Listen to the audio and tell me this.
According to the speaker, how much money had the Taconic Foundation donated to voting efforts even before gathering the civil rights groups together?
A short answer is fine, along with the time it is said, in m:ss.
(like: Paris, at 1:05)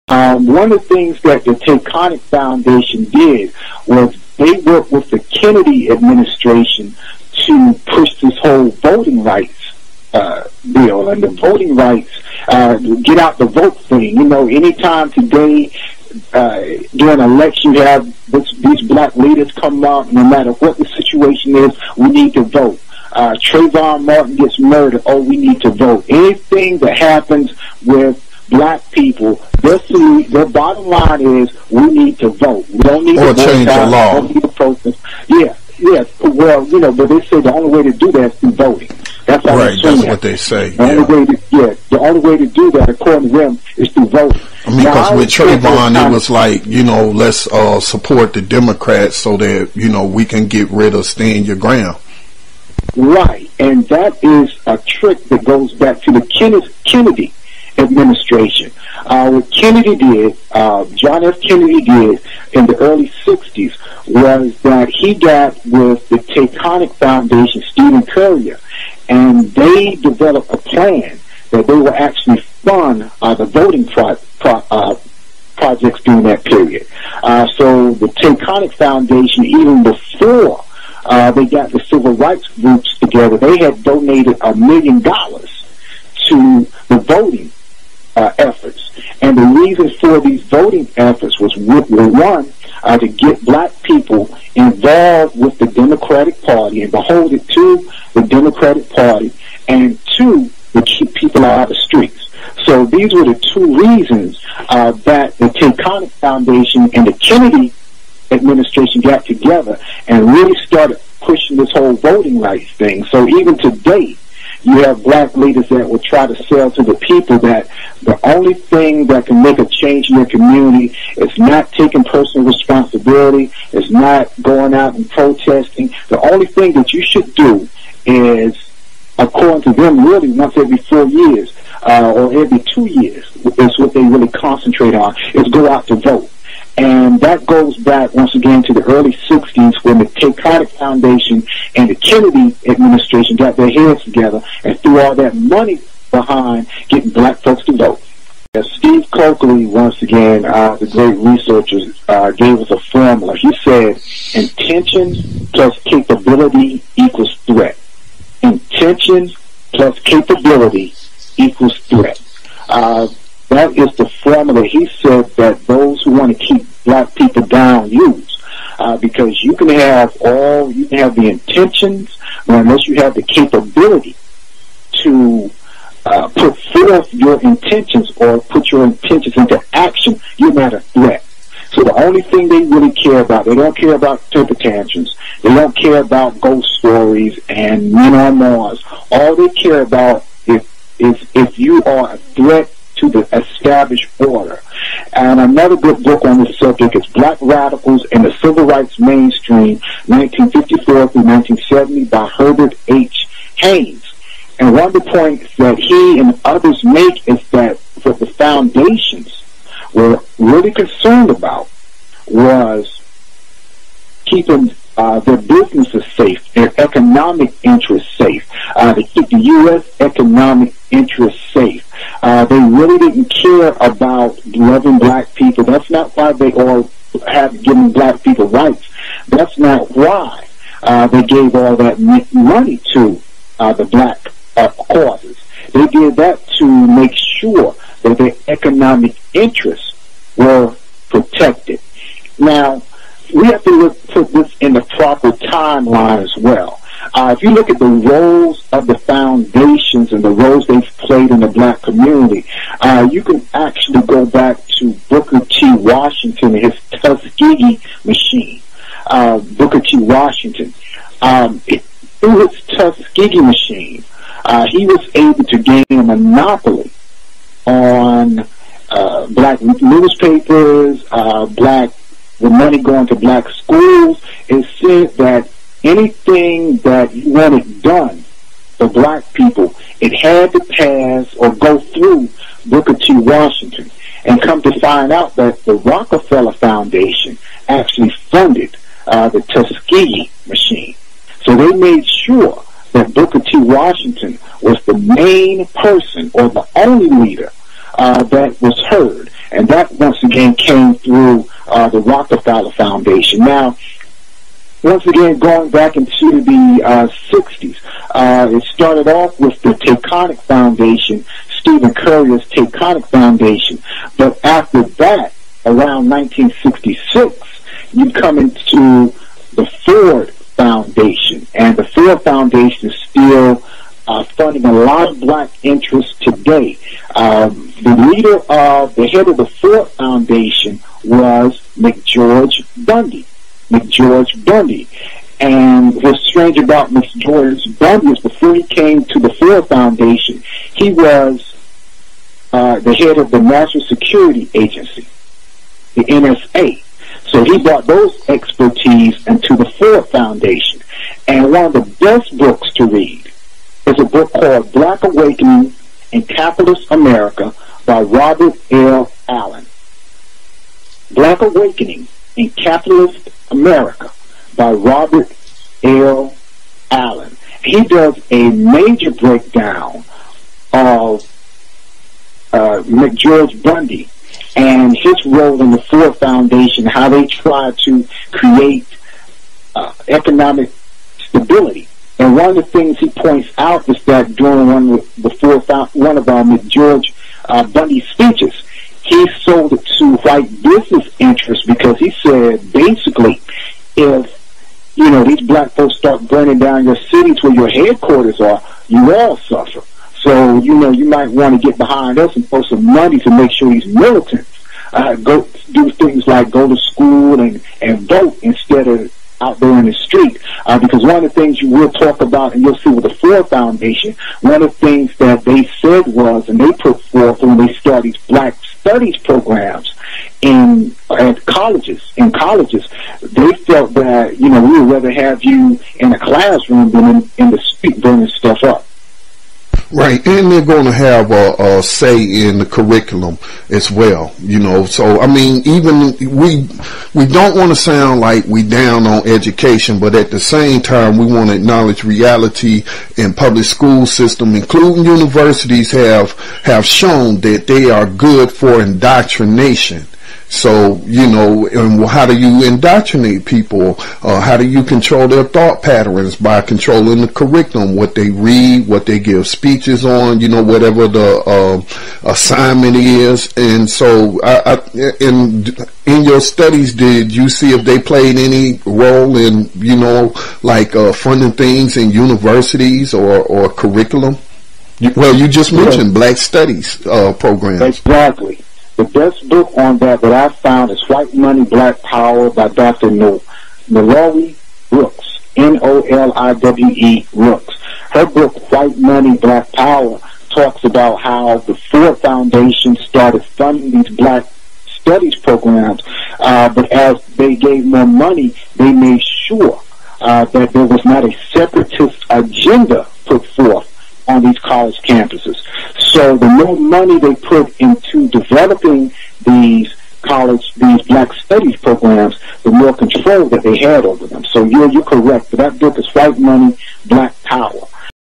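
a million dollars, at 1:24.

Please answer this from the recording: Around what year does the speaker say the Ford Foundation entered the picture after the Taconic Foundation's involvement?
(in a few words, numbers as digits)
1966.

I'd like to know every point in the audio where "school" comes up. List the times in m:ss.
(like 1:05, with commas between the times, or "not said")
4:33, 6:46, 7:23.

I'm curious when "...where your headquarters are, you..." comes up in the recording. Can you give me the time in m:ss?
6:37.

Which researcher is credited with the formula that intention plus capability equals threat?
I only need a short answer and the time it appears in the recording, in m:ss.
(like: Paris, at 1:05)
Steve Cokely, at 2:28.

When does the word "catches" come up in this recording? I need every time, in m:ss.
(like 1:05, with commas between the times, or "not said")
not said.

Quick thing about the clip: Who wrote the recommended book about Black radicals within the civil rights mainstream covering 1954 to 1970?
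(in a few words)
Herbert H. Haines.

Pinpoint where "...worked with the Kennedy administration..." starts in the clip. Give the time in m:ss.
0:04.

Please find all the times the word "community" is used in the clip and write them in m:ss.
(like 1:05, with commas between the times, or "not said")
2:00, 4:11.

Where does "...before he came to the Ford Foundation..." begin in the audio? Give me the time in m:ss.
5:38.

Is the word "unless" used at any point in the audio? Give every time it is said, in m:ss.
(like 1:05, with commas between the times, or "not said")
2:52.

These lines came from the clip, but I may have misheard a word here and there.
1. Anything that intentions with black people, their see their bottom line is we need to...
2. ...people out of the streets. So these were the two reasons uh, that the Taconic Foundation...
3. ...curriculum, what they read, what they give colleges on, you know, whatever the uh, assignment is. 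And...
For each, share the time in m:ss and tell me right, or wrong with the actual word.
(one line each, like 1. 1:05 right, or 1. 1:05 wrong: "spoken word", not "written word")
1. 0:26 wrong: "happens", not "intentions"
2. 1:41 right
3. 7:37 wrong: "speeches", not "colleges".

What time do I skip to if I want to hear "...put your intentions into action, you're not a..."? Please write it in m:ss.
2:58.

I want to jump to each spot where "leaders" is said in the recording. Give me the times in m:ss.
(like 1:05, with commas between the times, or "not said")
0:19, 1:55, 4:57, 5:28.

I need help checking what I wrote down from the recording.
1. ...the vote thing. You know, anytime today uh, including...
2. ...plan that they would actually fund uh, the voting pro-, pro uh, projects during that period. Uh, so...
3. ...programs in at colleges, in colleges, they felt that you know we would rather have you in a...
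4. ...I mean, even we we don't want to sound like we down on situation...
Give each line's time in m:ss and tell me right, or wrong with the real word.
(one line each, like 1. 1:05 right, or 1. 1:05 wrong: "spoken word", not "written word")
1. 0:13 wrong: "during", not "including"
2. 1:10 right
3. 6:59 right
4. 7:15 wrong: "education", not "situation".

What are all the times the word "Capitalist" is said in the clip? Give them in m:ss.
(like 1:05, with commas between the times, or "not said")
5:56, 6:02.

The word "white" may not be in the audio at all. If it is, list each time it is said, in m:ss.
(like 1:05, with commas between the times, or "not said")
6:30, 8:01, 8:08, 8:36.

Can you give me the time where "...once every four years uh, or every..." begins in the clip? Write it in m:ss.
2:10.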